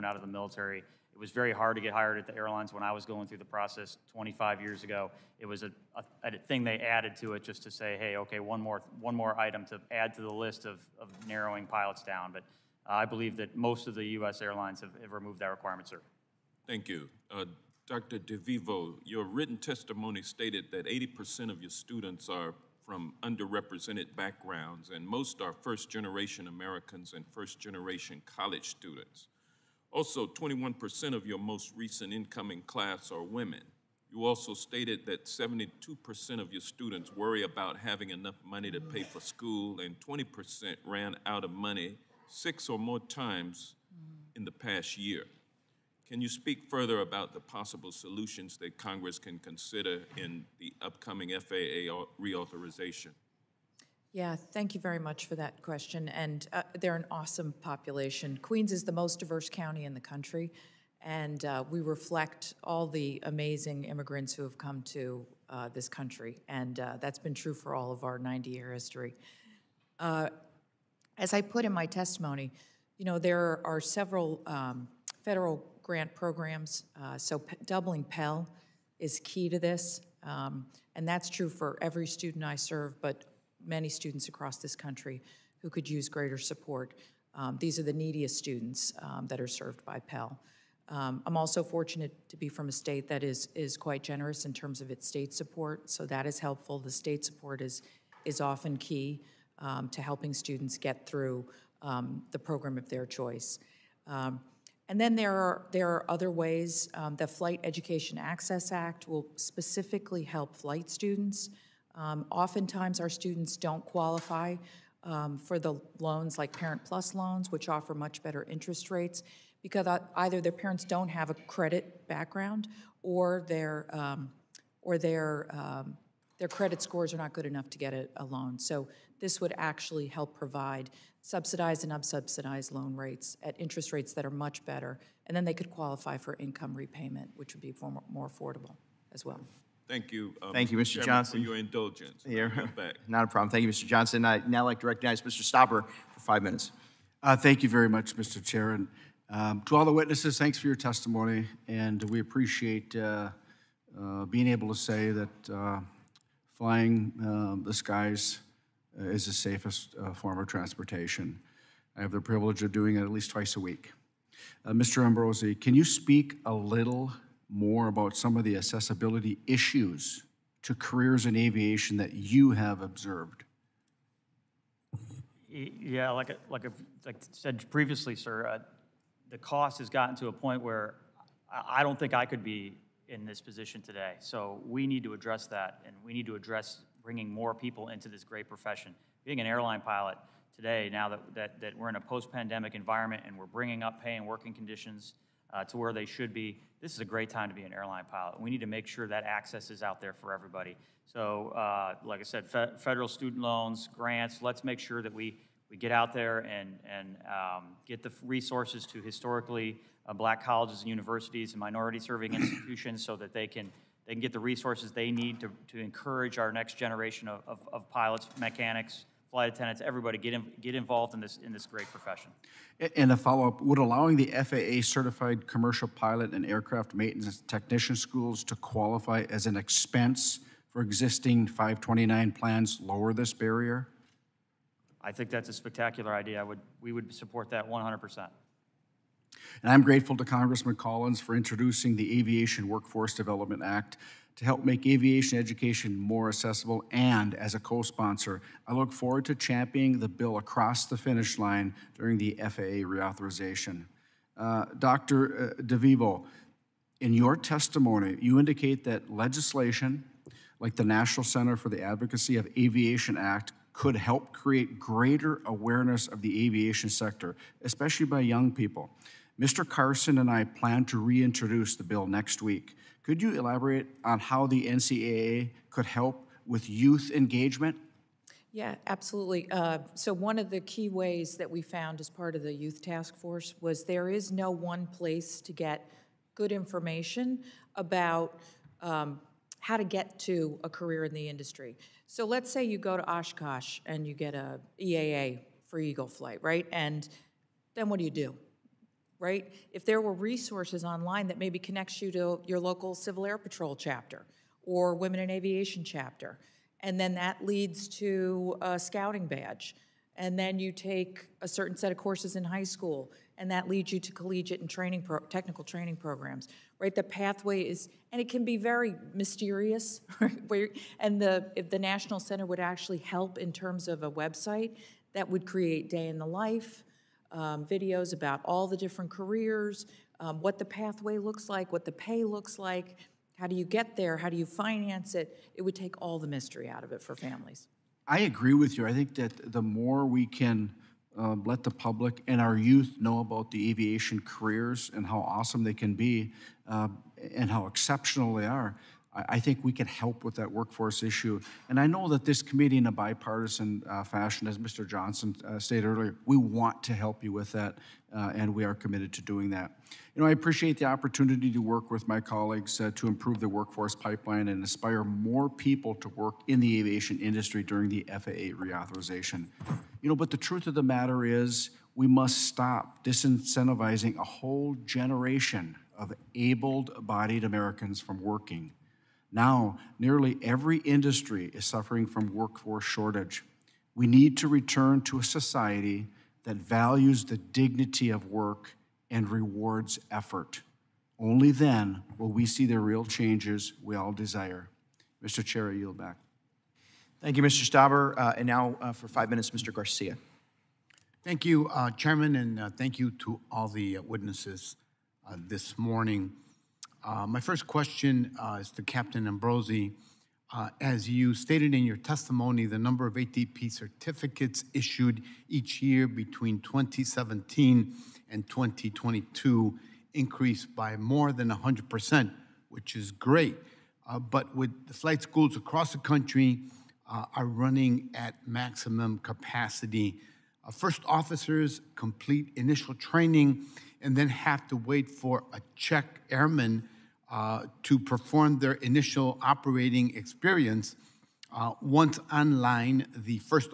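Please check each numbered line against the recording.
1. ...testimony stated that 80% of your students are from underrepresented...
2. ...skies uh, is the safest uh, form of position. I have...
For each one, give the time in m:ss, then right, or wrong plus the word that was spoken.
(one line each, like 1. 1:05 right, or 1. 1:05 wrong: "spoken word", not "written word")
1. 0:19 right
2. 2:37 wrong: "transportation", not "position".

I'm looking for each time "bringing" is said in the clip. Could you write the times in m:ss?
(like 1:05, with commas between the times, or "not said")
3:07, 3:13.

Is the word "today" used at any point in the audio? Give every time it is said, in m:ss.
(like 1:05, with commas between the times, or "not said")
3:03, 3:10.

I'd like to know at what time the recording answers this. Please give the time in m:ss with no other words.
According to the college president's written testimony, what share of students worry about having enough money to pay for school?
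0:35.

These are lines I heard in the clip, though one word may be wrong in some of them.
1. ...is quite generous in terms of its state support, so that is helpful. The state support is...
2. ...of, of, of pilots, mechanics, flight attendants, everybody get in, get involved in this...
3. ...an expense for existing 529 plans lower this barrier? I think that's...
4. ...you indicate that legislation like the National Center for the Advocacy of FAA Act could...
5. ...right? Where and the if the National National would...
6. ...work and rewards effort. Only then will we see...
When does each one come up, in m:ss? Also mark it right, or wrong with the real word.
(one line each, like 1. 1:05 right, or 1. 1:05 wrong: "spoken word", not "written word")
1. 1:33 right
2. 3:37 right
3. 3:49 right
4. 4:18 wrong: "Aviation", not "FAA"
5. 5:20 wrong: "Center", not "National"
6. 6:28 right.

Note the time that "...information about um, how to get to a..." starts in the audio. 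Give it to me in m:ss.
4:46.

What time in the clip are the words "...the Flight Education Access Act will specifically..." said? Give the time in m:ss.
1:47.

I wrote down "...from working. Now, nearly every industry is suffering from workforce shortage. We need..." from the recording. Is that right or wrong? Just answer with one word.
right.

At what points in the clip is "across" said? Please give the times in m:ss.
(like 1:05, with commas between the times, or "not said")
1:24, 4:10, 7:05.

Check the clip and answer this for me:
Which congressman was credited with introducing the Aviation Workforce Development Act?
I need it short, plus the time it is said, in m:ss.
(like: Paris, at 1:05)
Collins, at 4:00.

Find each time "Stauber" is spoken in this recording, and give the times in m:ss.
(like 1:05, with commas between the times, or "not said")
2:25, 6:37.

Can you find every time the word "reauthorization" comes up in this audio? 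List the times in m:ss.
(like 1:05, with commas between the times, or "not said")
0:52, 4:12, 6:08.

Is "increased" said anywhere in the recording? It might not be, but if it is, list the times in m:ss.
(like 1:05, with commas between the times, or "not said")
7:00.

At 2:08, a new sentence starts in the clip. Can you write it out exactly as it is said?
So this would actually help provide subsidized and unsubsidized loan rates at interest rates that are much better.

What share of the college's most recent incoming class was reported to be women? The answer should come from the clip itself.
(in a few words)
21%.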